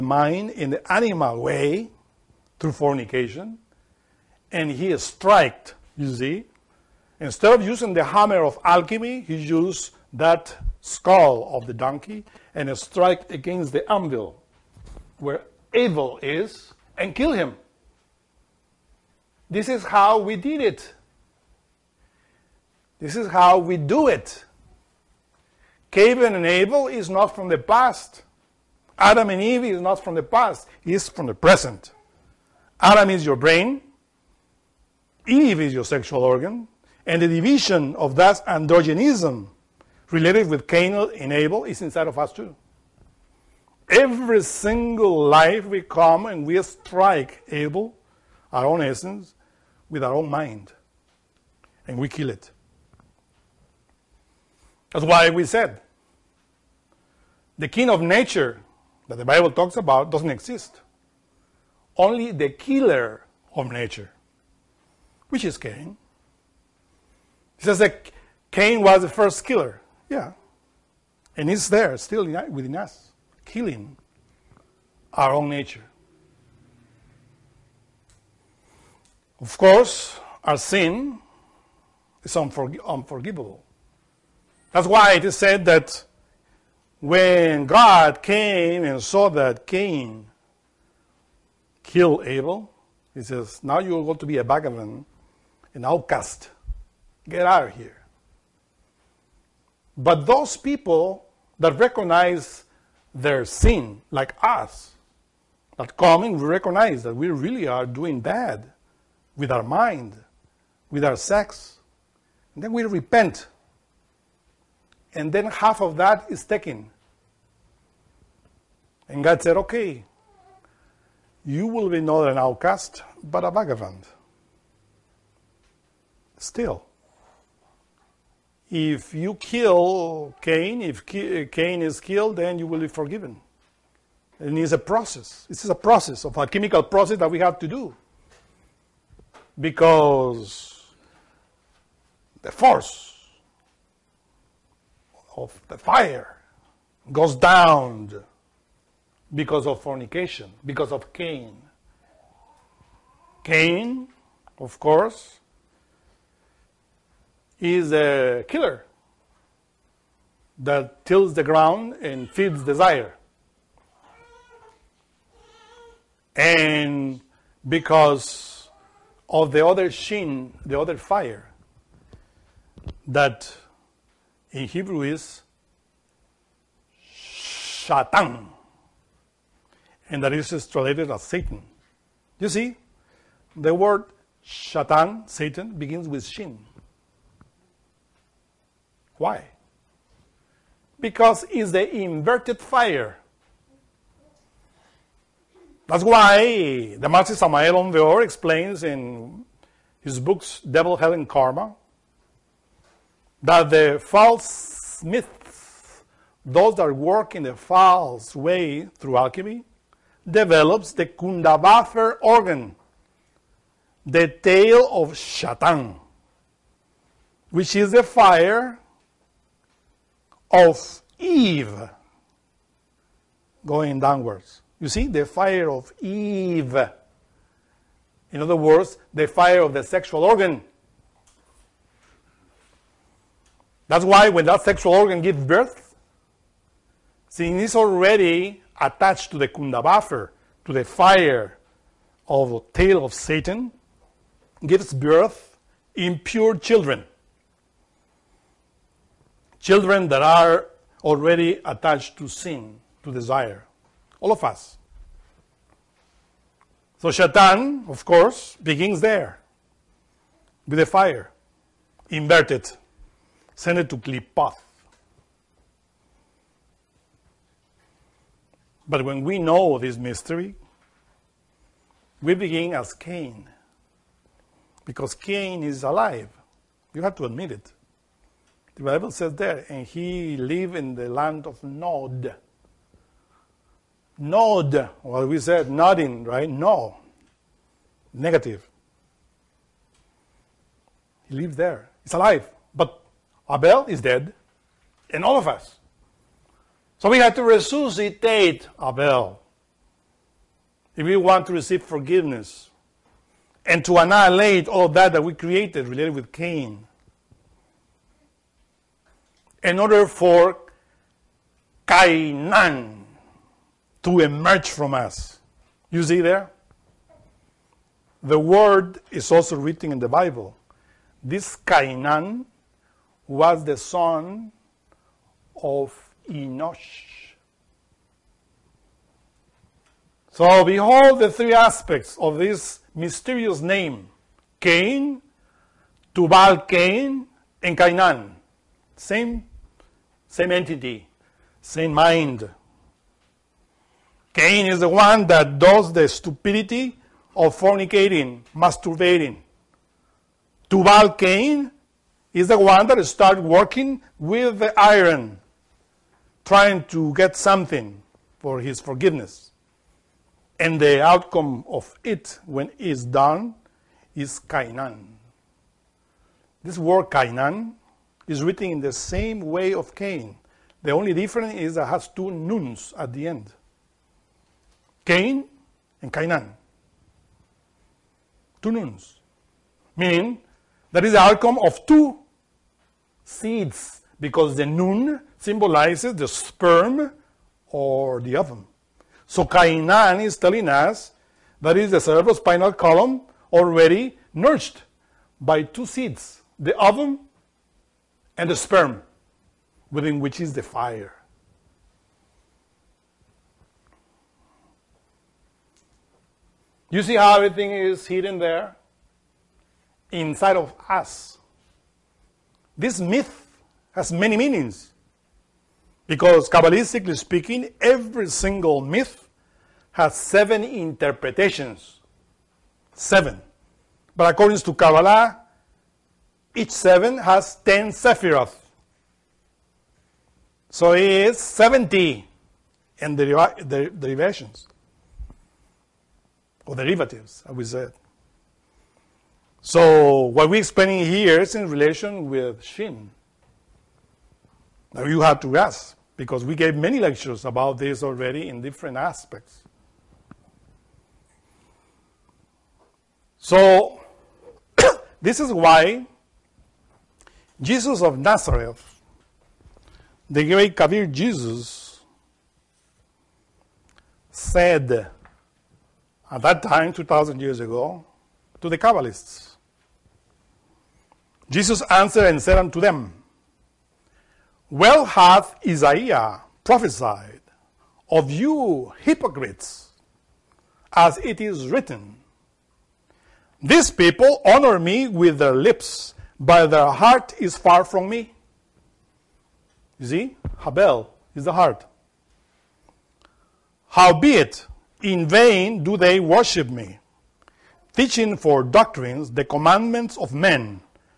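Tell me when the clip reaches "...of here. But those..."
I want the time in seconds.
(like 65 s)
97 s.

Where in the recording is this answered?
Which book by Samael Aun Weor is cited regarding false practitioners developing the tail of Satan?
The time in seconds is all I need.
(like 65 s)
200 s.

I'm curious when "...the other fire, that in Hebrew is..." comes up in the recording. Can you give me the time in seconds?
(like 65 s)
170 s.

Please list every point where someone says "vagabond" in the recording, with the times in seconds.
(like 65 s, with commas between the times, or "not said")
94 s, 123 s.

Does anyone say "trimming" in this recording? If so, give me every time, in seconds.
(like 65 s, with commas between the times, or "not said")
not said.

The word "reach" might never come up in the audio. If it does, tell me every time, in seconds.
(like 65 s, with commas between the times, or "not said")
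not said.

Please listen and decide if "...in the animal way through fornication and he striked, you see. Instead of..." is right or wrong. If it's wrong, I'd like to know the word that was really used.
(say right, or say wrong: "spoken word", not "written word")
right.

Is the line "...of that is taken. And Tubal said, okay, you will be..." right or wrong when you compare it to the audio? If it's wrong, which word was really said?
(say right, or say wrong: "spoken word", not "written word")
wrong: "God", not "Tubal".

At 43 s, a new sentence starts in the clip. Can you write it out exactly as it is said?
Every single life we come and we strike Abel, our own essence, with our own mind, and we kill it.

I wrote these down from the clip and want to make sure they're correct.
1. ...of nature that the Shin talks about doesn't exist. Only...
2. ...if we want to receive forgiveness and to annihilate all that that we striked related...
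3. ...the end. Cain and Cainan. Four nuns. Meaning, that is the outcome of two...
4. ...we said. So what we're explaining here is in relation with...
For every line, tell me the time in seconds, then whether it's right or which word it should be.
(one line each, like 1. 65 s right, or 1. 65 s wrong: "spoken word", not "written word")
1. 57 s wrong: "Bible", not "Shin"
2. 300 s wrong: "created", not "striked"
3. 373 s wrong: "Two", not "Four"
4. 437 s right.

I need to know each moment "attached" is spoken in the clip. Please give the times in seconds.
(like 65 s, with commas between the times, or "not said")
238 s, 251 s.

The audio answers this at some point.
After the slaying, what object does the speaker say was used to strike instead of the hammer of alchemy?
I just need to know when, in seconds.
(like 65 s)
10 s.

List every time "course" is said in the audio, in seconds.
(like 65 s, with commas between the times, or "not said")
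79 s, 154 s, 258 s.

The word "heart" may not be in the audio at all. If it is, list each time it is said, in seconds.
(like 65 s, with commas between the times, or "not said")
486 s, 491 s.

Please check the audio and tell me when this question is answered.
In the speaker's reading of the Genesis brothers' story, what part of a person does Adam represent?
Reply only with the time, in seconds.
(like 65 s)
33 s.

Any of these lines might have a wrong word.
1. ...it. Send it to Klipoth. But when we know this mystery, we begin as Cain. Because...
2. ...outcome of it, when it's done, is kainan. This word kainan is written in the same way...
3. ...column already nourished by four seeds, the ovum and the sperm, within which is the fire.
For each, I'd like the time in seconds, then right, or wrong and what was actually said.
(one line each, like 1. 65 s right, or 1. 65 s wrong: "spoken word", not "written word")
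1. 262 s right
2. 361 s right
3. 392 s wrong: "two", not "four".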